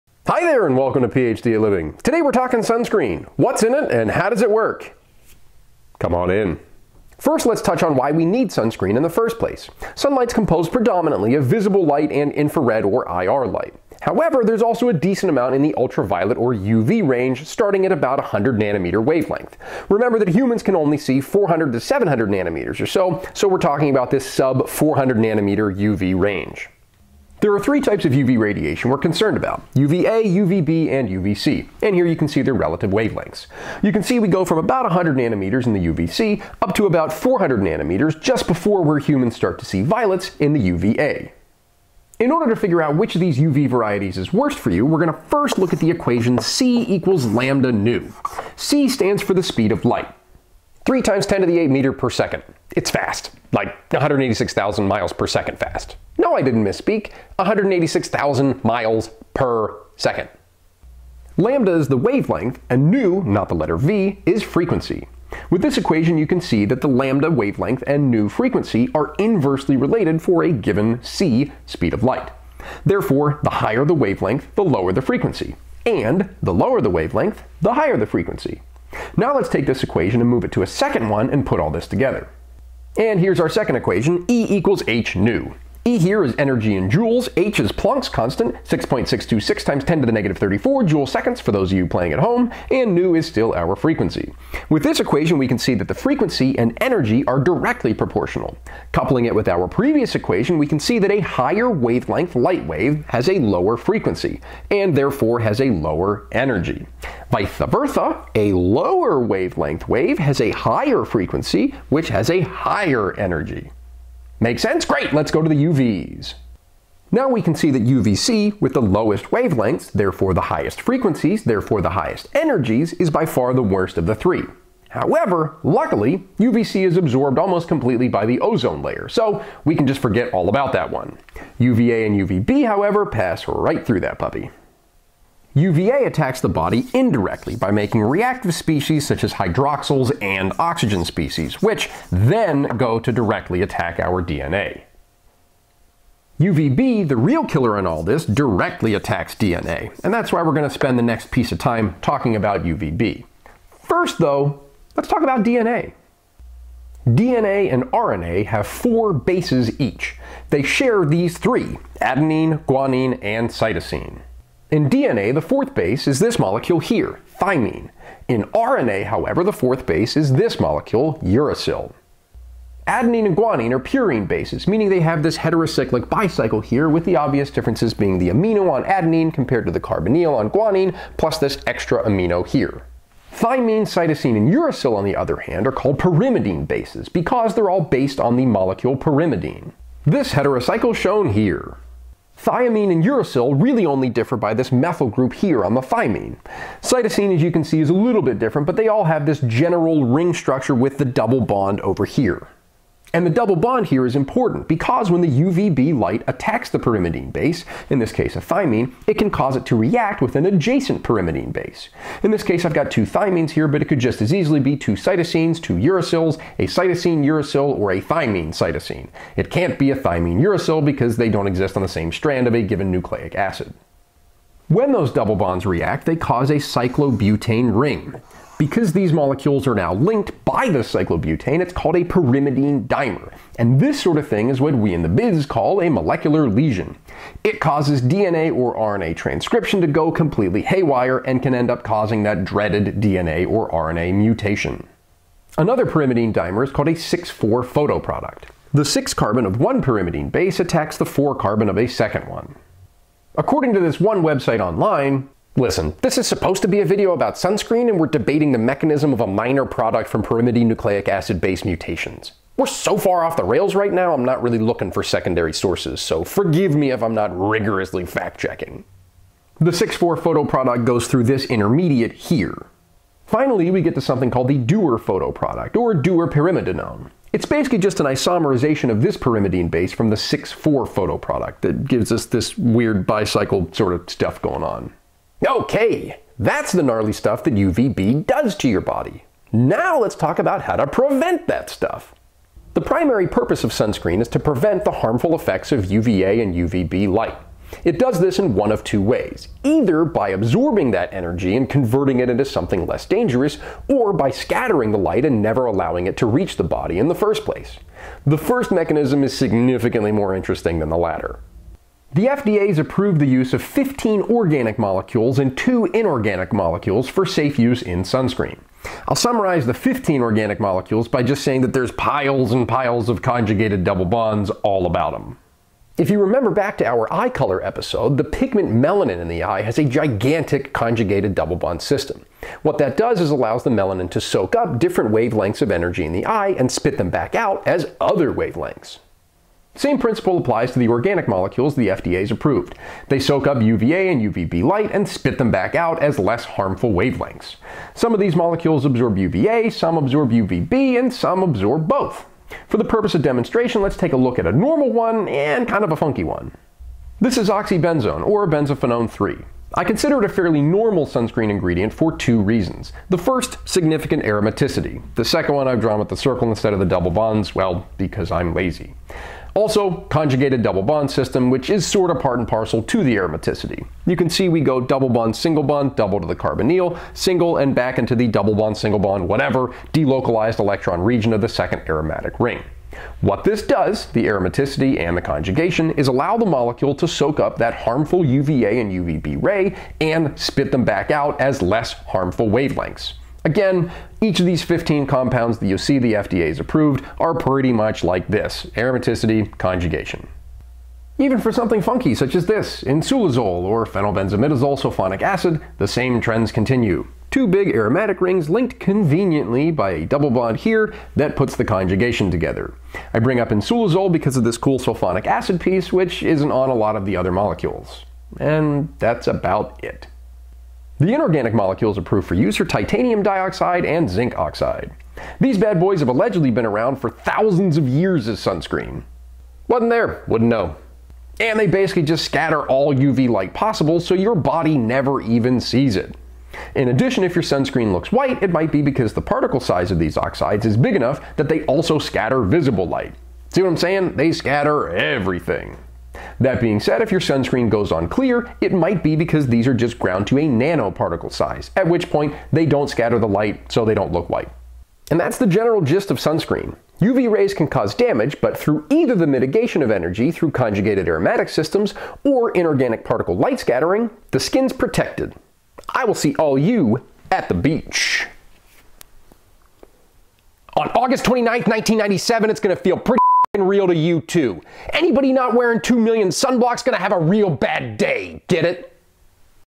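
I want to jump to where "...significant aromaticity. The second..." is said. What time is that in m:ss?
6:03.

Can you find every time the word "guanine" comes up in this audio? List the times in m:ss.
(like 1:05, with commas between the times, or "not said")
2:42, 2:53, 3:00.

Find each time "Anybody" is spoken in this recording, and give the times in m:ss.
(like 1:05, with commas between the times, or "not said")
7:54.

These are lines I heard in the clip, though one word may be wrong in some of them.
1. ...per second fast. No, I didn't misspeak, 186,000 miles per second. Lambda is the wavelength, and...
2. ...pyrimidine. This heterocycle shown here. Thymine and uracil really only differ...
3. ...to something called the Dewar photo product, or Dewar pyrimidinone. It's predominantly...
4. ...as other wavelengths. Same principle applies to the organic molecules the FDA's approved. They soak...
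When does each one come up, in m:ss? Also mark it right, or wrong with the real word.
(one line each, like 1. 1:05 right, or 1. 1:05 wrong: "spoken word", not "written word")
1. 0:55 right
2. 3:08 right
3. 4:33 wrong: "basically", not "predominantly"
4. 5:37 right.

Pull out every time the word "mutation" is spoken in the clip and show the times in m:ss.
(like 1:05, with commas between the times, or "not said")
4:04, 4:21.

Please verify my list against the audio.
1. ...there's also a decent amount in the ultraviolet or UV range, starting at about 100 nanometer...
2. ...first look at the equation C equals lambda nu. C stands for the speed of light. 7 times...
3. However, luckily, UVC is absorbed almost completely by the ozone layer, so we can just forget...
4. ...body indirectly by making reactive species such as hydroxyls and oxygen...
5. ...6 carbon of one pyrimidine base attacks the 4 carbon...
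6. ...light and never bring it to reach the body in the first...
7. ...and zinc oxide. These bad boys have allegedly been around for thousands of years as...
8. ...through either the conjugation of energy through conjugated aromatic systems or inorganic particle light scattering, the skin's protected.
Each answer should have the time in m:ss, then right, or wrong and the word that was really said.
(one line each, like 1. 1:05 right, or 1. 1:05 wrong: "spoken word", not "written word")
1. 0:14 right
2. 0:45 wrong: "3", not "7"
3. 2:04 right
4. 2:16 right
5. 4:08 right
6. 5:04 wrong: "allowing", not "bring"
7. 7:03 right
8. 7:38 wrong: "mitigation", not "conjugation".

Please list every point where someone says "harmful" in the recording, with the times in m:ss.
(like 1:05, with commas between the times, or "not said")
4:54, 5:46, 6:27, 6:31.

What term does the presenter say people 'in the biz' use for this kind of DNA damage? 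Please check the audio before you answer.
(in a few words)
molecular lesion.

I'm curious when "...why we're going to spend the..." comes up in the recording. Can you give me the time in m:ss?
2:30.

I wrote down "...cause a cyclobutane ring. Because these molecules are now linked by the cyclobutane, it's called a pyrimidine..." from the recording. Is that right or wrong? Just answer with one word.
right.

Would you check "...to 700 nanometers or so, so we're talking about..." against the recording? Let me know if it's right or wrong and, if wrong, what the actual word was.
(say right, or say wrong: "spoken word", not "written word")
right.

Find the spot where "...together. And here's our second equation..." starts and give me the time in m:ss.
1:21.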